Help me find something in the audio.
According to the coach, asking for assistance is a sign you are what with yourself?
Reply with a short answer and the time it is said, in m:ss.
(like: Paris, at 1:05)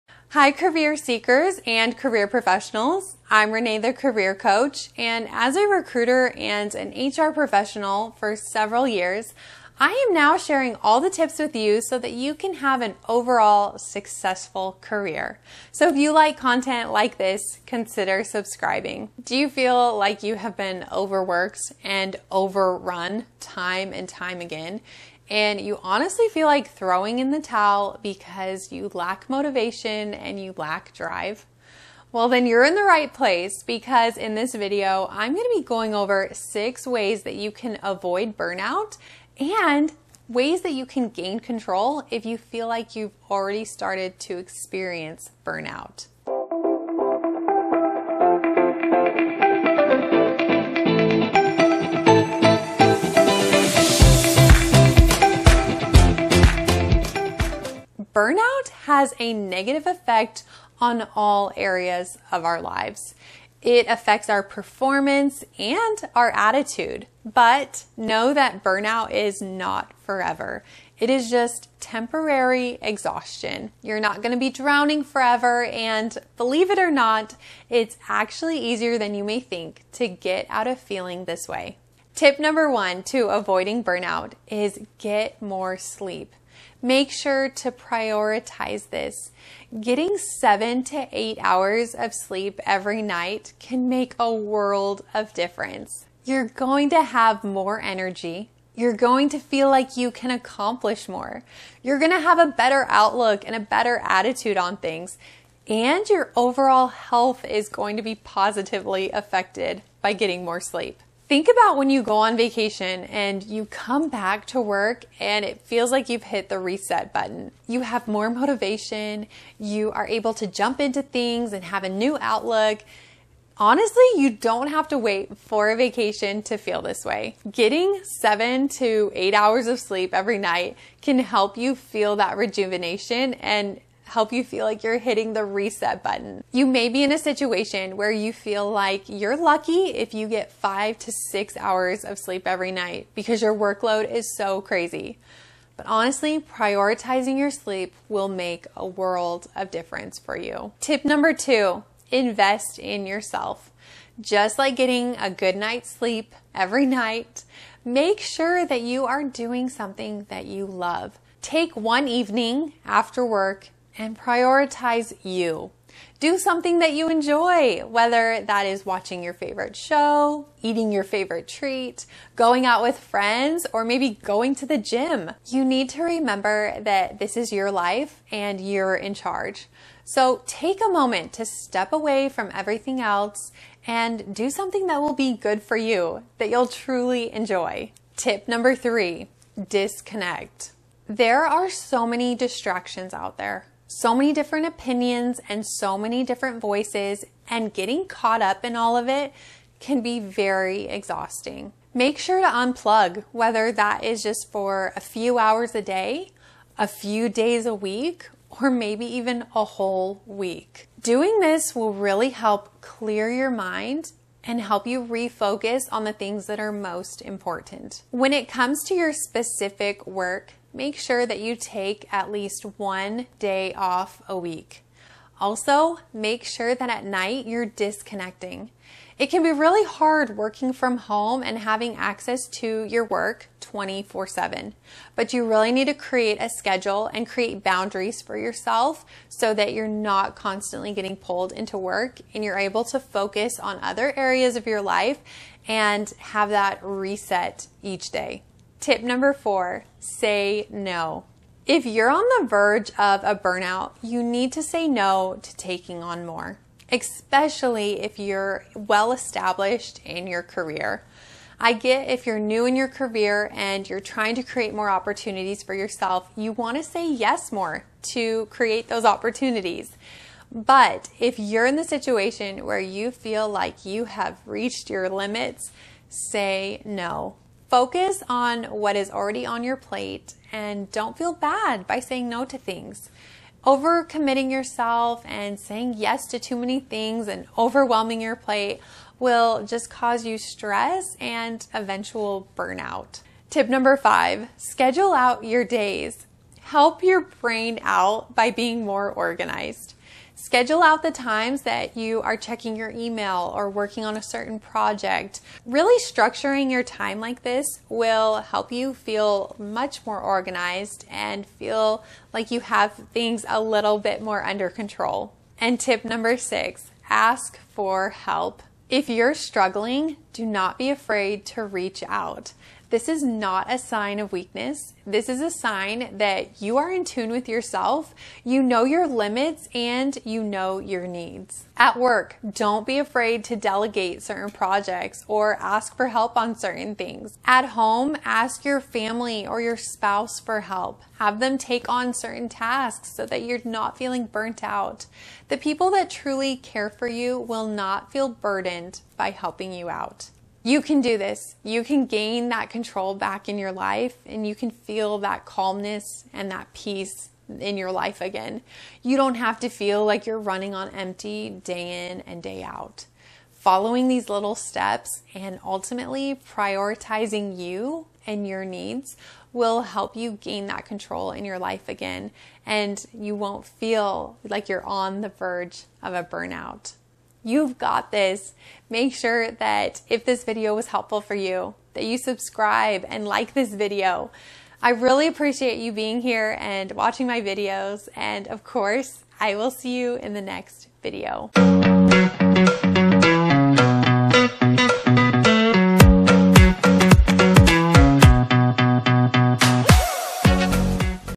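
In tune, at 5:26.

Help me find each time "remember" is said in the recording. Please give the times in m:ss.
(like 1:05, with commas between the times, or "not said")
2:56.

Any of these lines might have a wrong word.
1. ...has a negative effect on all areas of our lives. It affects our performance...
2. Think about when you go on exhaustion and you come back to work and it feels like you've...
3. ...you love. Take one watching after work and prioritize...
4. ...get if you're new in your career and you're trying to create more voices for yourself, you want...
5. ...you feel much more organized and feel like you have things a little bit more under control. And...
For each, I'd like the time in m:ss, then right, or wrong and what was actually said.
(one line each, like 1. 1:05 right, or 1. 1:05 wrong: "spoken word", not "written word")
1. 0:58 right
2. 1:51 wrong: "vacation", not "exhaustion"
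3. 2:40 wrong: "evening", not "watching"
4. 4:21 wrong: "opportunities", not "voices"
5. 5:08 right.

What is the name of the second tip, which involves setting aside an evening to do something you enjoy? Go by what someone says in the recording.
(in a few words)
Invest in yourself.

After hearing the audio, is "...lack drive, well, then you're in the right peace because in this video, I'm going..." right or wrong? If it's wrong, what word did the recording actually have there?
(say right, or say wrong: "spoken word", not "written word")
wrong: "place", not "peace".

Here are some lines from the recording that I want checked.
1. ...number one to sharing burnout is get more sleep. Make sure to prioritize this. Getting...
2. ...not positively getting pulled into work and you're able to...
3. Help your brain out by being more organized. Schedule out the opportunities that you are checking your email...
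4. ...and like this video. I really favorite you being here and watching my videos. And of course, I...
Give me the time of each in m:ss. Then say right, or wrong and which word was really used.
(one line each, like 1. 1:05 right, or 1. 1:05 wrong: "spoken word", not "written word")
1. 1:22 wrong: "avoiding", not "sharing"
2. 3:59 wrong: "constantly", not "positively"
3. 4:56 wrong: "times", not "opportunities"
4. 6:23 wrong: "appreciate", not "favorite".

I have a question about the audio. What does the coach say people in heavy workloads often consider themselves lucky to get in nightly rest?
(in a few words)
5 to 6 hours.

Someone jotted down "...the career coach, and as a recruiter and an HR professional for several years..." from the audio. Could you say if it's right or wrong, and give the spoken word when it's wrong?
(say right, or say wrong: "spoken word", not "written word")
right.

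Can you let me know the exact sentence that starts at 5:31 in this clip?
At work, don't be afraid to delegate certain projects or ask for help on certain things.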